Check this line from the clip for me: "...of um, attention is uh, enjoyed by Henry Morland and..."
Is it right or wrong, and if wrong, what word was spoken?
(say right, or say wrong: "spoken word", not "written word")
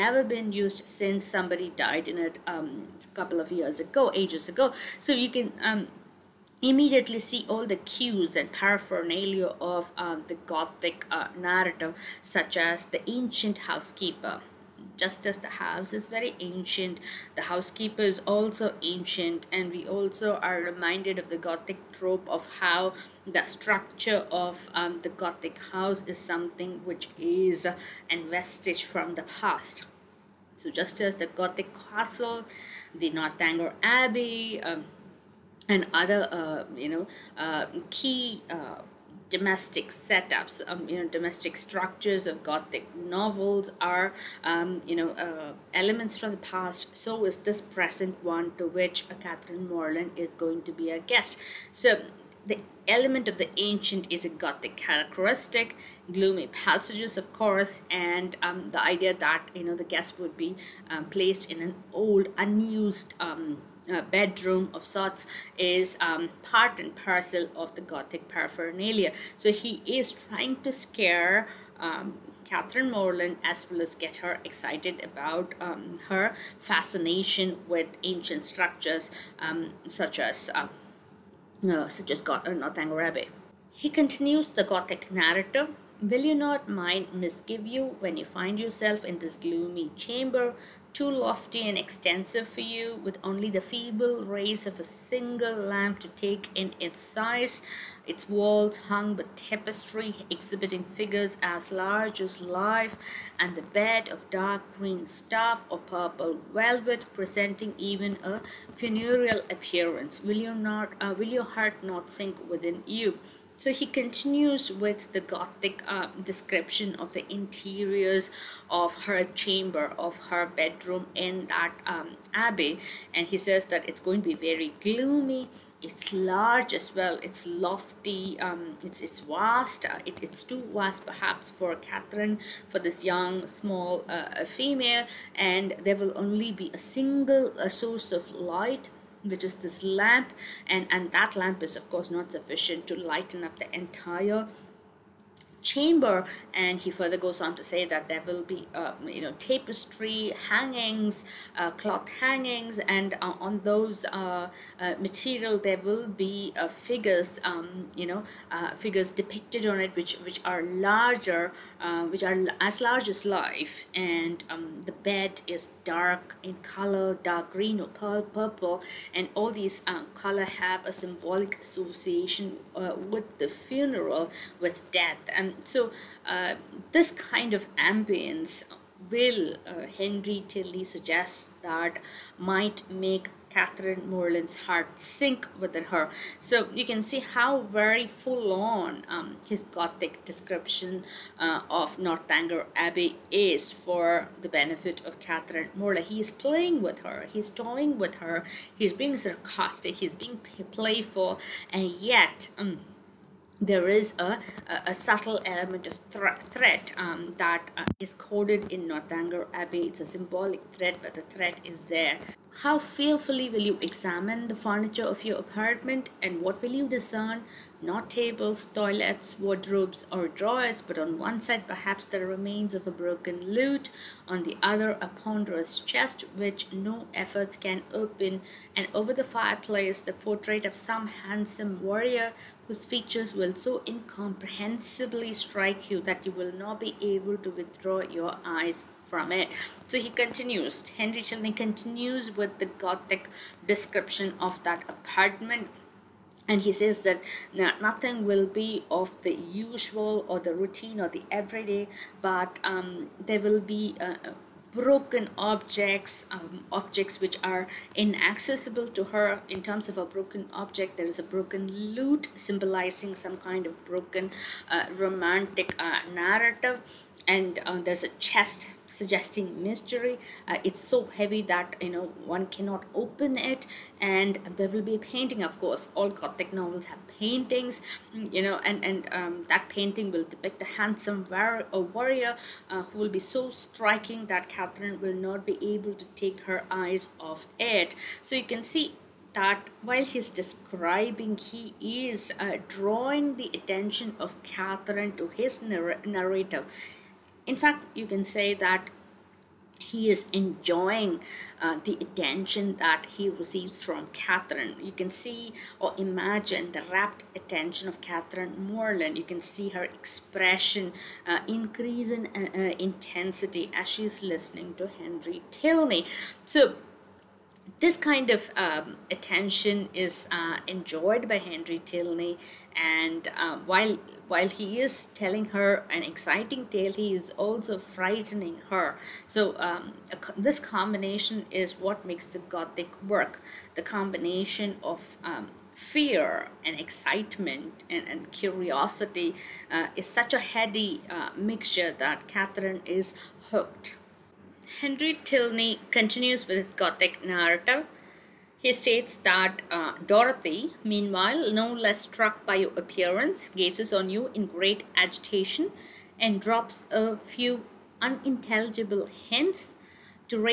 wrong: "Tilney", not "Morland".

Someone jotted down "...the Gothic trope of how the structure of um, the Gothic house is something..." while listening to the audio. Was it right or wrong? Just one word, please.
right.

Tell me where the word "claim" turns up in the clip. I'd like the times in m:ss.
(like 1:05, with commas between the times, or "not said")
not said.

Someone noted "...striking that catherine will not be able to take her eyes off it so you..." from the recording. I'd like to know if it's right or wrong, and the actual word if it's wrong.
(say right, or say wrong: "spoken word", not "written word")
right.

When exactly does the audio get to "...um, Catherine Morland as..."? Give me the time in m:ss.
1:11.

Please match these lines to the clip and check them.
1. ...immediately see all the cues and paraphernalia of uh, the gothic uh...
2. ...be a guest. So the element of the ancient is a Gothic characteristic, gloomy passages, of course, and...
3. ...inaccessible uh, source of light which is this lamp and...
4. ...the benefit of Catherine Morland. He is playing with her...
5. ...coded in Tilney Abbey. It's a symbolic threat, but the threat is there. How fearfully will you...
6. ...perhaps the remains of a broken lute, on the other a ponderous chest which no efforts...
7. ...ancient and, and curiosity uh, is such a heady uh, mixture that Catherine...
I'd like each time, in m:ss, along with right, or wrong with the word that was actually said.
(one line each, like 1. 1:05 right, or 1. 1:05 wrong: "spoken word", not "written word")
1. 0:06 right
2. 0:50 right
3. 2:16 wrong: "single", not "inaccessible"
4. 3:14 right
5. 3:28 wrong: "Northanger", not "Tilney"
6. 3:41 right
7. 5:36 wrong: "excitement", not "ancient".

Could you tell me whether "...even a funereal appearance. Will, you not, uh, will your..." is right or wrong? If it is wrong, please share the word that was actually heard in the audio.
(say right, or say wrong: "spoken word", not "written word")
right.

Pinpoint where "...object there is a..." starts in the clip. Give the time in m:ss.
4:20.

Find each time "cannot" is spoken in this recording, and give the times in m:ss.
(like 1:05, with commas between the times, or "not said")
4:32.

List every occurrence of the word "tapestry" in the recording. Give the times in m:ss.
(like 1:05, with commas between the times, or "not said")
1:39, 2:29.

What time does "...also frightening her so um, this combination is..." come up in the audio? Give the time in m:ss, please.
5:27.